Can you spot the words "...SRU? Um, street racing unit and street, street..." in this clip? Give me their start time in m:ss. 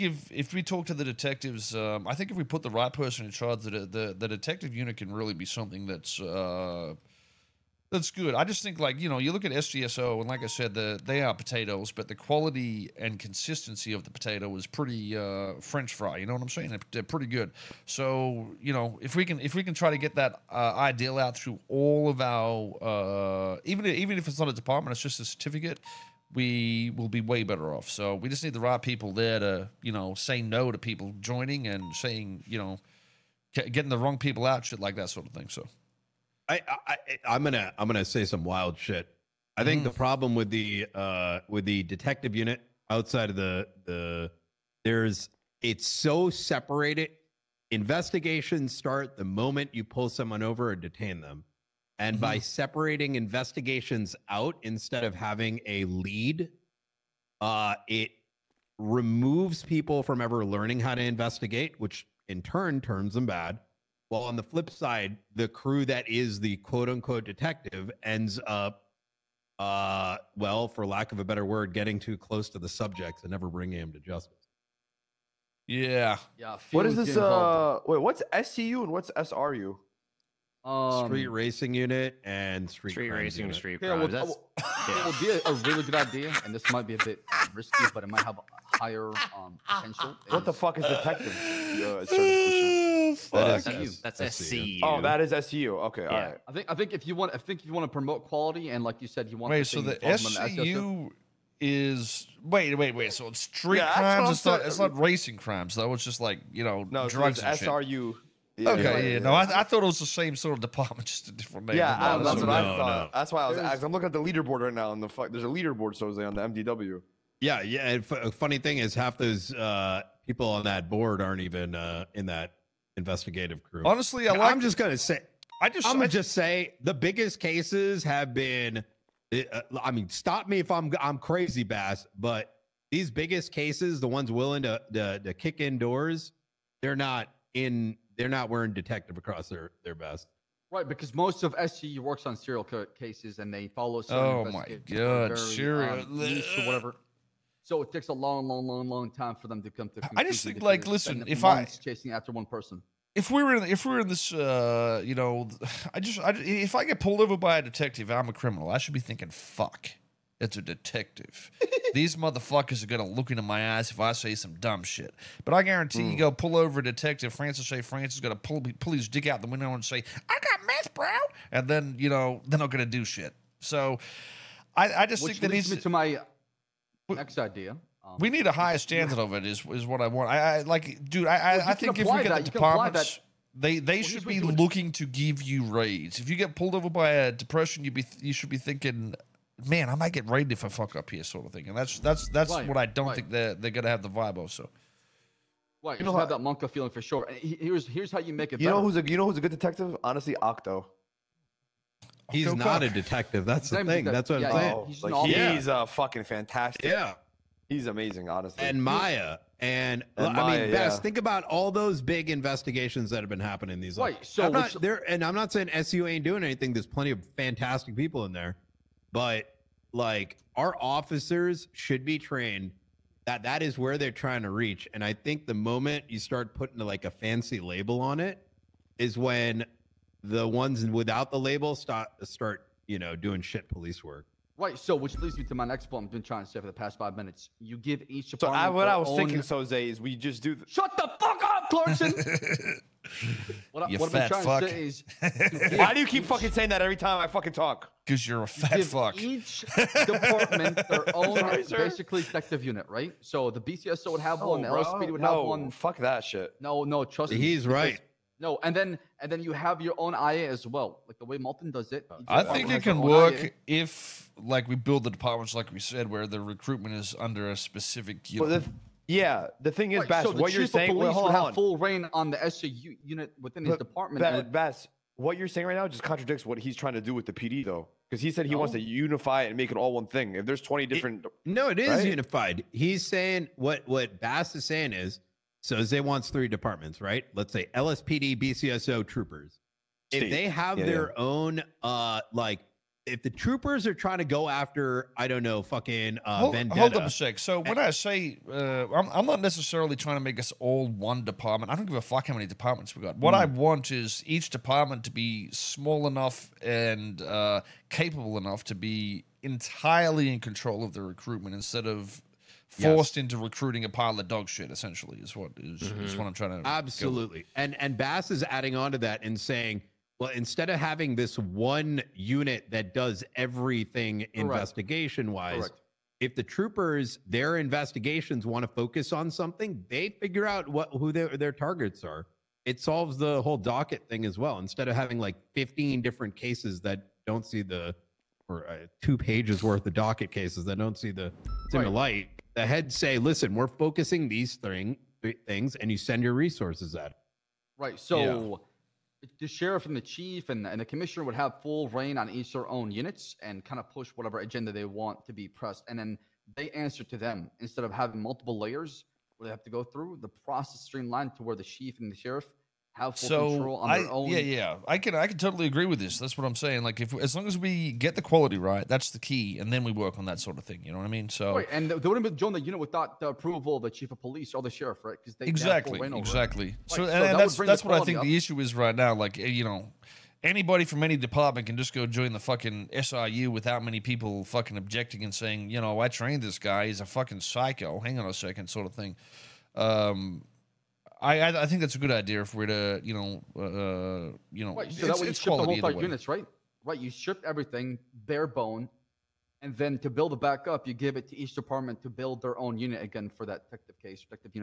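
1:19.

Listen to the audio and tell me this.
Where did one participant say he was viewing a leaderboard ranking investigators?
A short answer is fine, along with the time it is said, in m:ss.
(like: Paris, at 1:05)
The MDW, at 1:56.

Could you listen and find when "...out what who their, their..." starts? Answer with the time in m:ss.
5:30.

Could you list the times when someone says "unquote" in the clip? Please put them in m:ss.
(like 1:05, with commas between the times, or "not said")
1:06.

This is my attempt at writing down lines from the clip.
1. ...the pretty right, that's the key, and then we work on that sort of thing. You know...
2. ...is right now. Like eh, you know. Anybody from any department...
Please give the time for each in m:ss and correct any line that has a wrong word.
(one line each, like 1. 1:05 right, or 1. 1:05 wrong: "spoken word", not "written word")
1. 6:08 wrong: "quality", not "pretty"
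2. 6:18 right.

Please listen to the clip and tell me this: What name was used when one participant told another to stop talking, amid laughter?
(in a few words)
Clarkson.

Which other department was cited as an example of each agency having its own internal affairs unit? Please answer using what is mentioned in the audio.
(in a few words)
Malton.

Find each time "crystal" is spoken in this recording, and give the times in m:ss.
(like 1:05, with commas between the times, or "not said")
not said.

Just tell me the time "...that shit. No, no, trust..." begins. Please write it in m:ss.
4:15.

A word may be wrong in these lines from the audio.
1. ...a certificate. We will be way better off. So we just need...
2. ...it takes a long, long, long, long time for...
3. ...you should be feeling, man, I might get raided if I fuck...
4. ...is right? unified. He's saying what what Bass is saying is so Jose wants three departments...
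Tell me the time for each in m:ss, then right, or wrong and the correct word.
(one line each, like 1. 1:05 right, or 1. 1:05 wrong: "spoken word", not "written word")
1. 0:25 right
2. 2:27 right
3. 3:08 wrong: "thinking", not "feeling"
4. 4:41 wrong: "Zay", not "Jose".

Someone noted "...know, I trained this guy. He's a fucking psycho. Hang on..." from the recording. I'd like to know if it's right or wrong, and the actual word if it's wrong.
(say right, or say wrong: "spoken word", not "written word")
right.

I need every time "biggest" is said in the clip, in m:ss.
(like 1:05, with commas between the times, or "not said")
2:06, 2:13.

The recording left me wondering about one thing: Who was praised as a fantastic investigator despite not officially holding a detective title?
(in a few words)
Octo.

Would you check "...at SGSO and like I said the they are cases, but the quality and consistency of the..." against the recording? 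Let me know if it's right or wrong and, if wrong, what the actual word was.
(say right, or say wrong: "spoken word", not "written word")
wrong: "potatoes", not "cases".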